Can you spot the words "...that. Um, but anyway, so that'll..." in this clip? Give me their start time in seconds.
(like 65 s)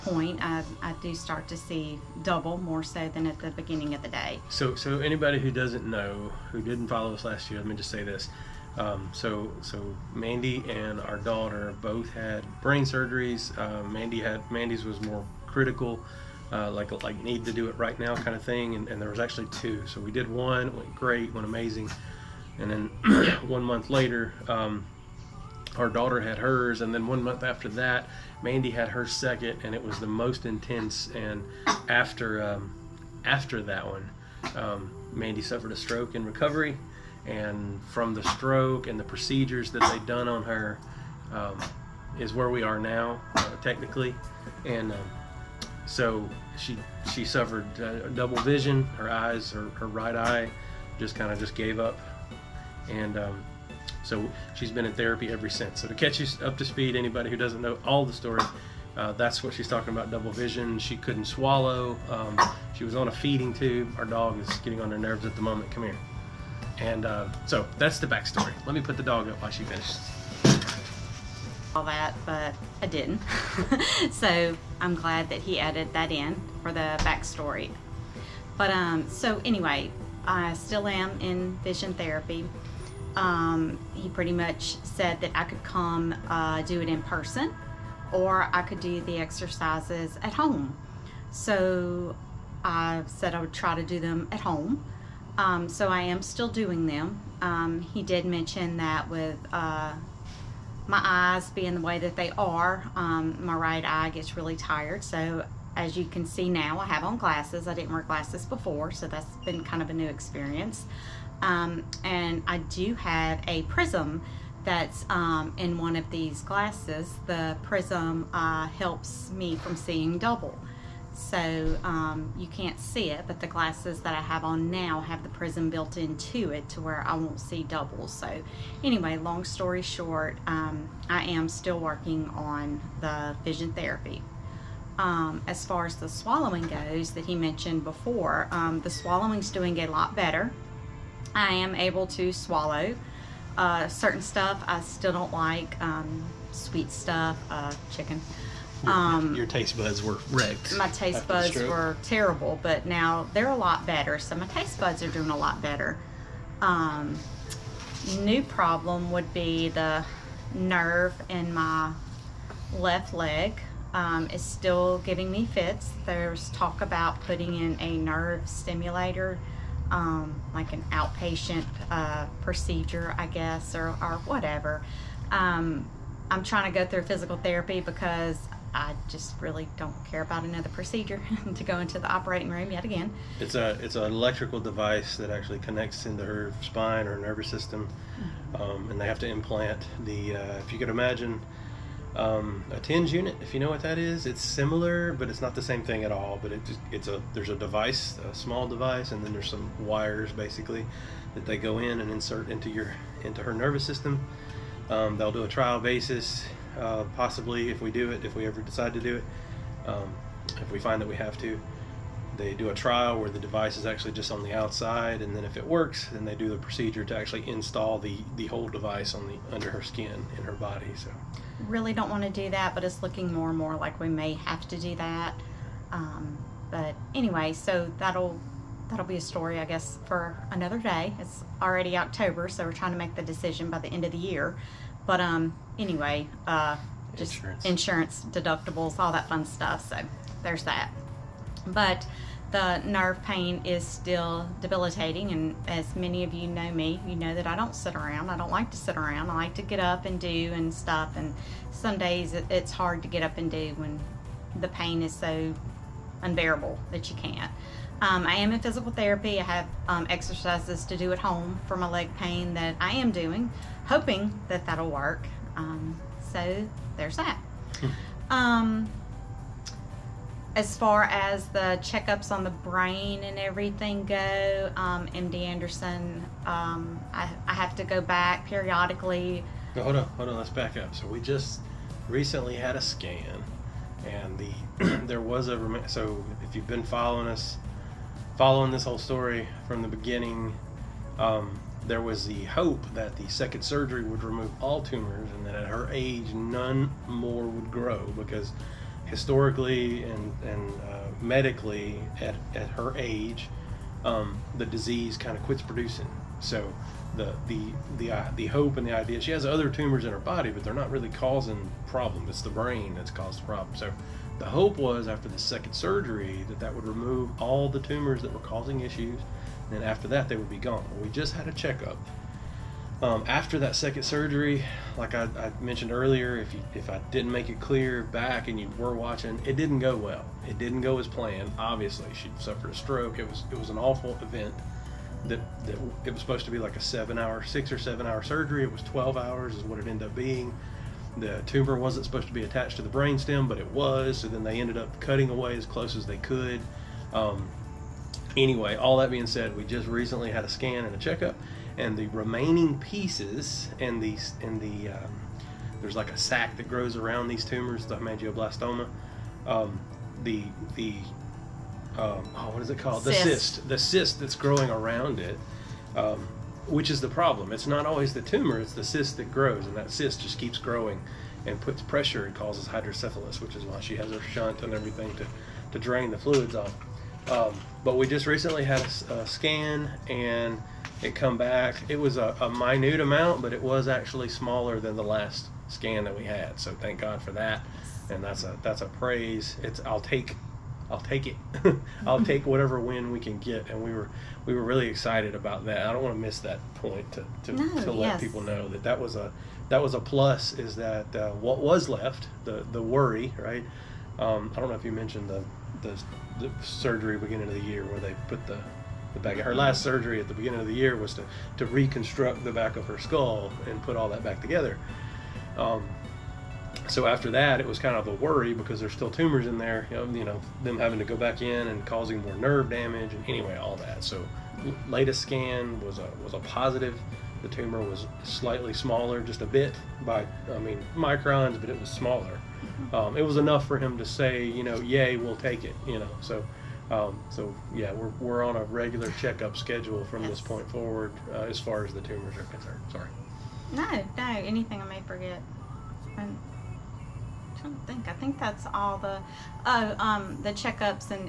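224 s.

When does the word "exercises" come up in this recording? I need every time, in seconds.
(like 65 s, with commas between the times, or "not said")
89 s, 260 s.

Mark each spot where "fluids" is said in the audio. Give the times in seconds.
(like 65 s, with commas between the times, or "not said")
376 s.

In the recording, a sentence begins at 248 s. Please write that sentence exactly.
I don't like to sit around.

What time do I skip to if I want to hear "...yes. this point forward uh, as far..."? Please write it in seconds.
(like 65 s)
440 s.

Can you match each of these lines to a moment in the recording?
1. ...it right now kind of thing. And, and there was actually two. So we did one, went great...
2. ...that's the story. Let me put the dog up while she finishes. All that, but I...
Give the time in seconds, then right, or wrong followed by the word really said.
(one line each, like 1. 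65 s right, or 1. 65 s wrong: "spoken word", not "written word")
1. 17 s right
2. 67 s wrong: "backstory", not "story".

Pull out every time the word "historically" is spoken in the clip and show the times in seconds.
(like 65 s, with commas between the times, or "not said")
299 s.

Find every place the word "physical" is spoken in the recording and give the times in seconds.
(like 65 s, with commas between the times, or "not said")
177 s, 258 s.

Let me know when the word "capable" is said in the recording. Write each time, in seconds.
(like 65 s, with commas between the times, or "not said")
not said.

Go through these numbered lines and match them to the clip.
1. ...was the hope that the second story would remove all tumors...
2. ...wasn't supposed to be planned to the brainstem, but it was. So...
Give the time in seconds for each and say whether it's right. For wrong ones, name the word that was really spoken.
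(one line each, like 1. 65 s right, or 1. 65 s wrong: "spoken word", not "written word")
1. 292 s wrong: "surgery", not "story"
2. 341 s wrong: "attached", not "planned".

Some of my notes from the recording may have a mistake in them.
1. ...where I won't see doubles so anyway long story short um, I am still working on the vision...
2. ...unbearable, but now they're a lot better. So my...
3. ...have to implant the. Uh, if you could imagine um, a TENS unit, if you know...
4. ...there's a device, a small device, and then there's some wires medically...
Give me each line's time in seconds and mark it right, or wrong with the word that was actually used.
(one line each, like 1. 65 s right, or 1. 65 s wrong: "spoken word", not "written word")
1. 126 s right
2. 152 s wrong: "terrible", not "unbearable"
3. 189 s right
4. 197 s wrong: "basically", not "medically".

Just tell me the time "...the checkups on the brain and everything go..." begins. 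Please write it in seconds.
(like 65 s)
271 s.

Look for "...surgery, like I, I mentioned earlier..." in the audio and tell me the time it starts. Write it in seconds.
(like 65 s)
324 s.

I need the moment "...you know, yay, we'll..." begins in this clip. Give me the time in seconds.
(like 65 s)
434 s.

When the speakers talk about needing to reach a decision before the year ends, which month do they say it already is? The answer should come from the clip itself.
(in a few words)
October.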